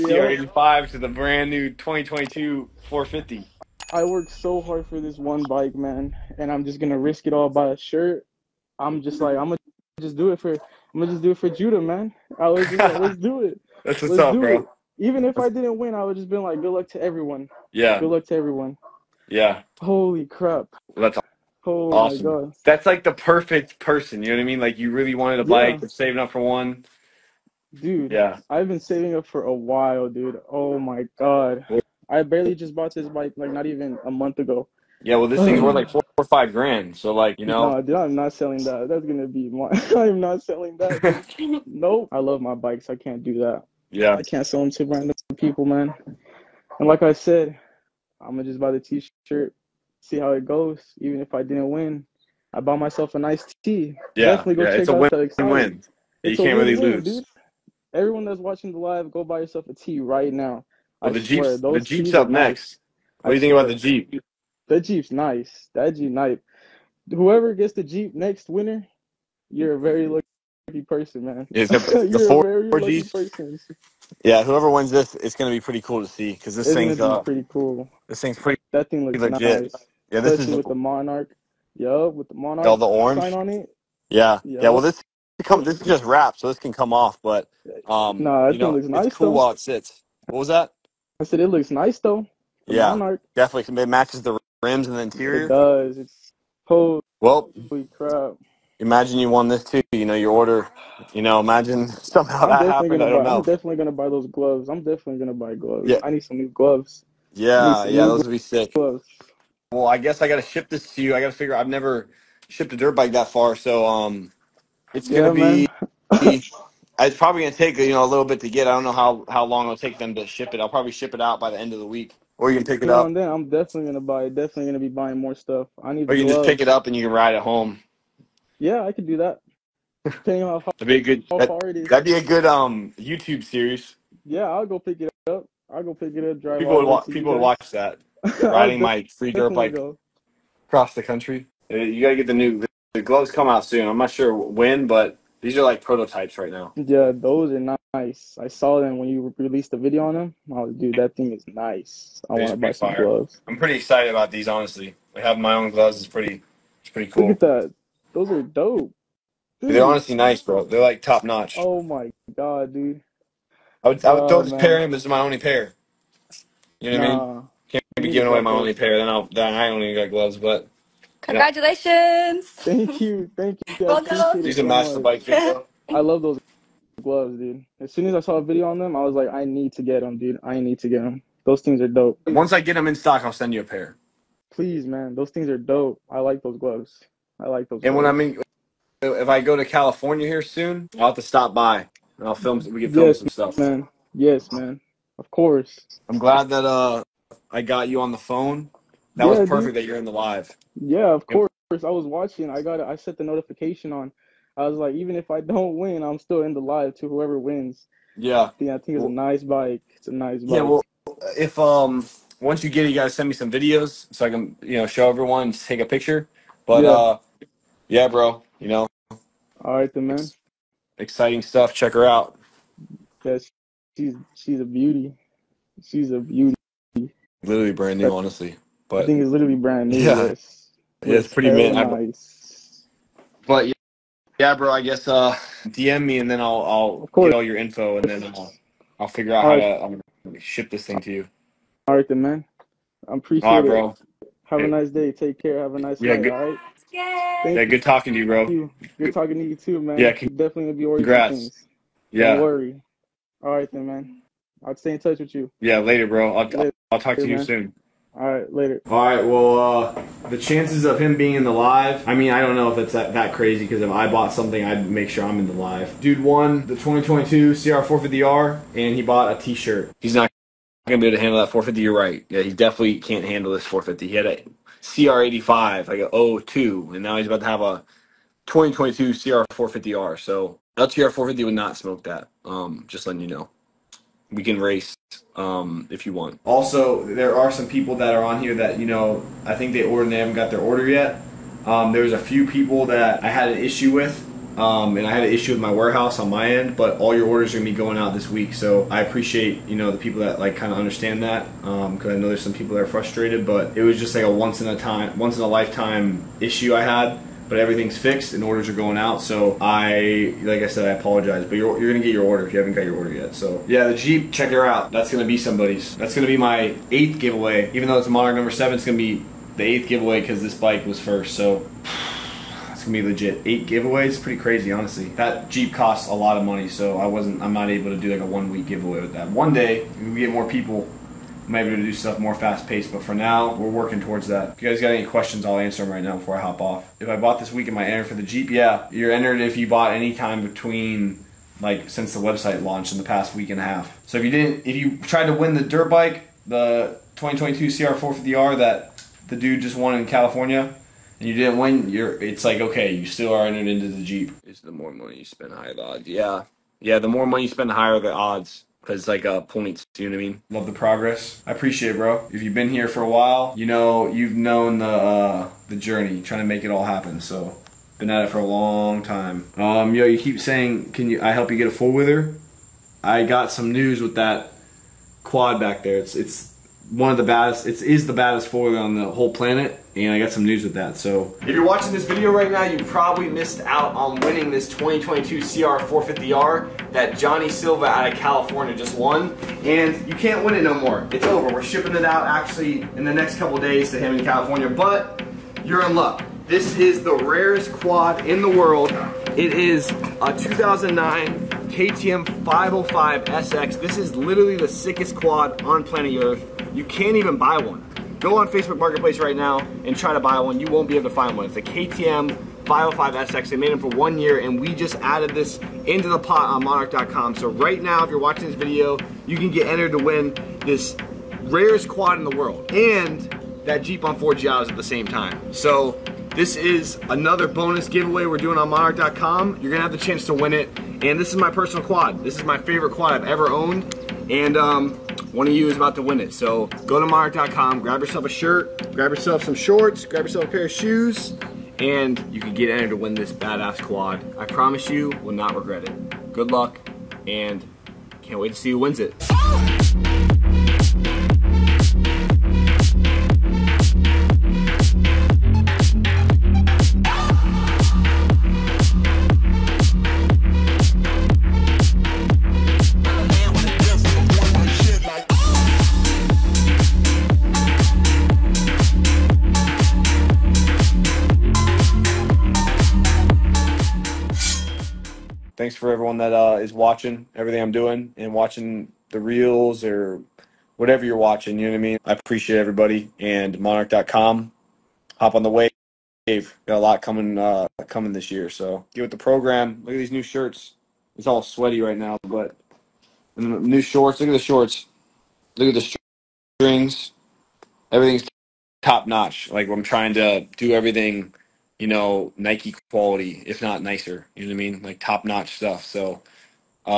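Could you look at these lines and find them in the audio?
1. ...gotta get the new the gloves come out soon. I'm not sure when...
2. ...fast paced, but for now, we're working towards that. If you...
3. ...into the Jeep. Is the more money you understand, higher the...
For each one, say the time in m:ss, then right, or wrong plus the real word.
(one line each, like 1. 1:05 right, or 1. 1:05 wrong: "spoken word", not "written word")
1. 2:22 right
2. 5:32 right
3. 5:53 wrong: "spend", not "understand".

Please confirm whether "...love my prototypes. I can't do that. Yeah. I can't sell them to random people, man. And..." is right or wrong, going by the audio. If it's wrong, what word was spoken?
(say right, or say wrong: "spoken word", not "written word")
wrong: "bikes", not "prototypes".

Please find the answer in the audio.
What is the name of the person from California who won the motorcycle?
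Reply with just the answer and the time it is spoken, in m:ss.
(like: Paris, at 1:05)
Johnny Silva, at 6:27.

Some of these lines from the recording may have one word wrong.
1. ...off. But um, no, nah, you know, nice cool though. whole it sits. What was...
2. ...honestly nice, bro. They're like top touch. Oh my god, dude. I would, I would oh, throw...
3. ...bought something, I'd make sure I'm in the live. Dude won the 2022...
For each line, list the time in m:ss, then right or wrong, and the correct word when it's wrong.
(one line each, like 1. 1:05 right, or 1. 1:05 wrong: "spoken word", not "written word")
1. 1:26 wrong: "while", not "whole"
2. 2:39 wrong: "notch", not "touch"
3. 4:24 right.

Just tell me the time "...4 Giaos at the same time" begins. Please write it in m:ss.
7:04.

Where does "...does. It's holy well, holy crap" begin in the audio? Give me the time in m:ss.
1:35.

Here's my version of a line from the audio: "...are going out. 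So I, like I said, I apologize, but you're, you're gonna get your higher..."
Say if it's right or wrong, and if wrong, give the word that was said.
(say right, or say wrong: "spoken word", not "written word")
wrong: "order", not "higher".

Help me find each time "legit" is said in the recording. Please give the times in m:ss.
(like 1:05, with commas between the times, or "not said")
1:19, 5:23.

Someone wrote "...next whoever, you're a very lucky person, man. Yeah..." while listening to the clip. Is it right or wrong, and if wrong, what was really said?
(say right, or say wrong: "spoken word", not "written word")
wrong: "winner", not "whoever".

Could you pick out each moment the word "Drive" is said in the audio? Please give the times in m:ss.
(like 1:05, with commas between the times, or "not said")
2:16.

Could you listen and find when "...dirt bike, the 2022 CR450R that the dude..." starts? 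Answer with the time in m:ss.
5:45.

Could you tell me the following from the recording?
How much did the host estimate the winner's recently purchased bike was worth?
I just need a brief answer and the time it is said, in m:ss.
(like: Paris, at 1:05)
four or five grand, at 0:35.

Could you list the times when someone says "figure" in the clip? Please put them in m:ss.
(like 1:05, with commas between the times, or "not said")
1:51, 3:59.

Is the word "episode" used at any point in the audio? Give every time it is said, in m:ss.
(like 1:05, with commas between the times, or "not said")
not said.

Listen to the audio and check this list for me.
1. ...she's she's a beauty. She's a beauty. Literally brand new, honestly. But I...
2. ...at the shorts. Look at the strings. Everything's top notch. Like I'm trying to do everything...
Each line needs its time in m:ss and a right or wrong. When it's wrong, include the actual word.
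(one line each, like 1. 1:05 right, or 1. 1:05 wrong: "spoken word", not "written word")
1. 3:43 right
2. 8:14 right.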